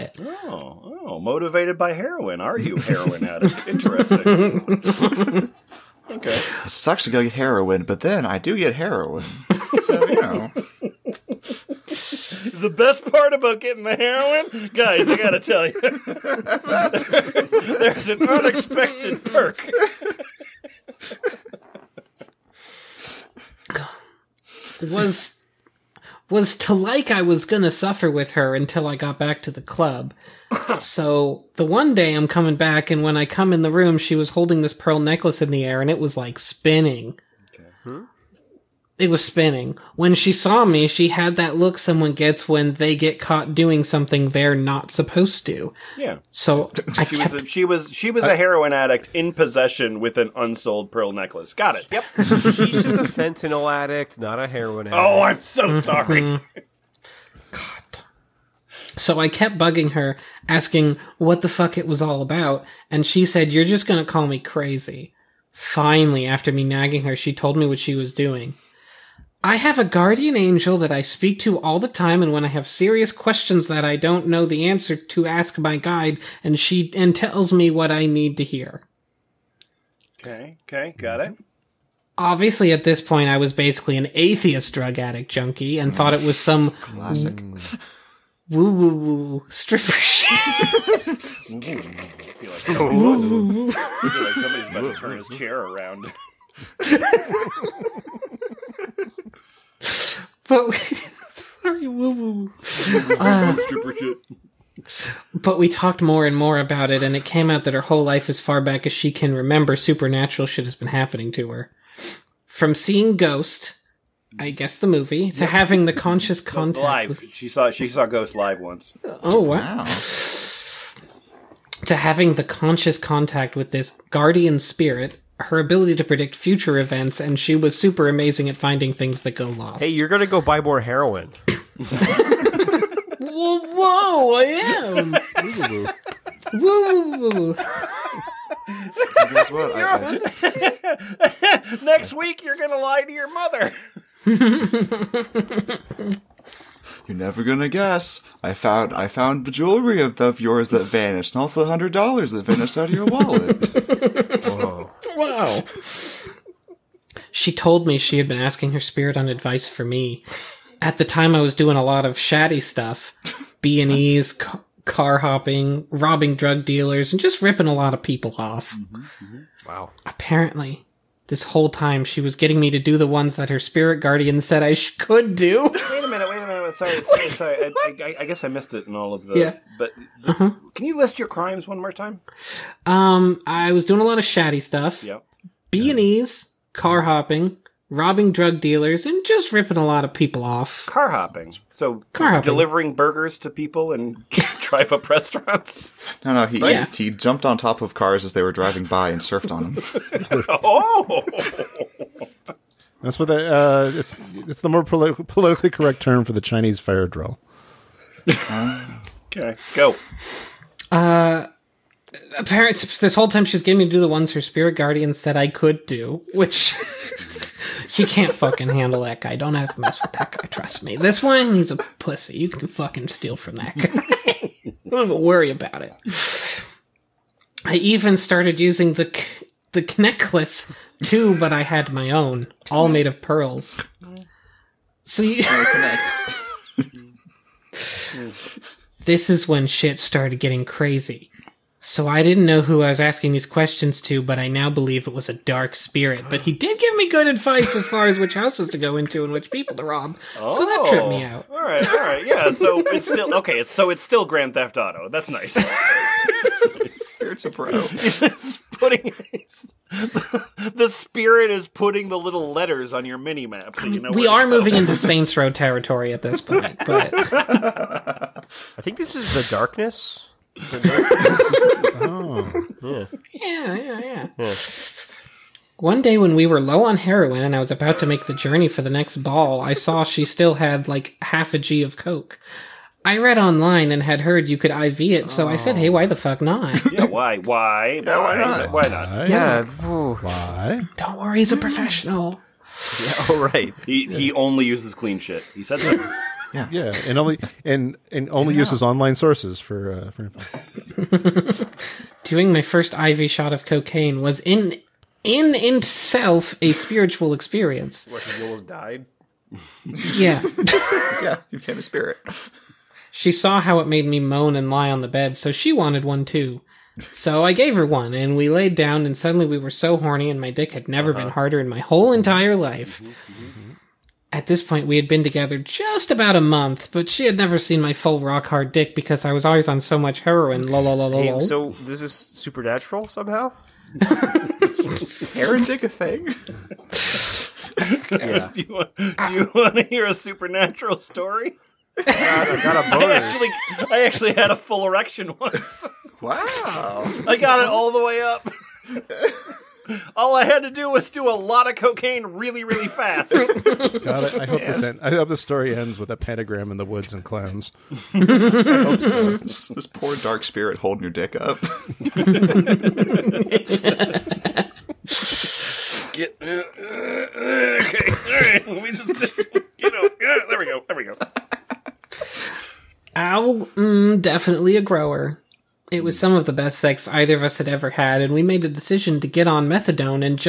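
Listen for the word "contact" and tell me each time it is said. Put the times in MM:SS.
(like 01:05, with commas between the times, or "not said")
01:56, 02:02.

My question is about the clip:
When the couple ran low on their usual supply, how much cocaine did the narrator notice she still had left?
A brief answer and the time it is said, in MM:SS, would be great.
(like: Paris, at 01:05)
half a G, at 04:41.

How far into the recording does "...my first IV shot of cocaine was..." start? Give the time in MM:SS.
05:02.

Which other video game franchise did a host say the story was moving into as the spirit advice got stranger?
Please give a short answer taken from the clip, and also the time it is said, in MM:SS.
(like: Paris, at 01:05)
Saints Row, at 04:24.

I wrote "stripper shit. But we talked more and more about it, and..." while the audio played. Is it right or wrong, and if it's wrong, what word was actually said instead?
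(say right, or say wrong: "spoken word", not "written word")
right.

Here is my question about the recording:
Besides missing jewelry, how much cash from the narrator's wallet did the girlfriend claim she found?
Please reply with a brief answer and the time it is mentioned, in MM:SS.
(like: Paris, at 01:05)
100 dollars, at 02:31.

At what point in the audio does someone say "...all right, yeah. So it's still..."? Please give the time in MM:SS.
04:11.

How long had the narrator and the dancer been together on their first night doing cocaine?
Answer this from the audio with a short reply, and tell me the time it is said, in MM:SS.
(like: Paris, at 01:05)
about a month, at 05:26.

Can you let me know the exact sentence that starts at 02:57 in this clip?
I, I, I, guess I missed it in all of the.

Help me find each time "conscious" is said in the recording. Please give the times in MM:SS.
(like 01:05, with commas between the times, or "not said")
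01:55, 02:02.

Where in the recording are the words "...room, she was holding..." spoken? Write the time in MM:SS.
00:33.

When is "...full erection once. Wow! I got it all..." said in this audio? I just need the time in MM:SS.
05:44.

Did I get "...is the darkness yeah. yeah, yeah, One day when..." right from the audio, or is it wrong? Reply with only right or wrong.
right.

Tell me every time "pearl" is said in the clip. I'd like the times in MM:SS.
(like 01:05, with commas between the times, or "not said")
00:34, 00:50, 03:53.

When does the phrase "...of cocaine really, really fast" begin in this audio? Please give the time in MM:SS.
05:51.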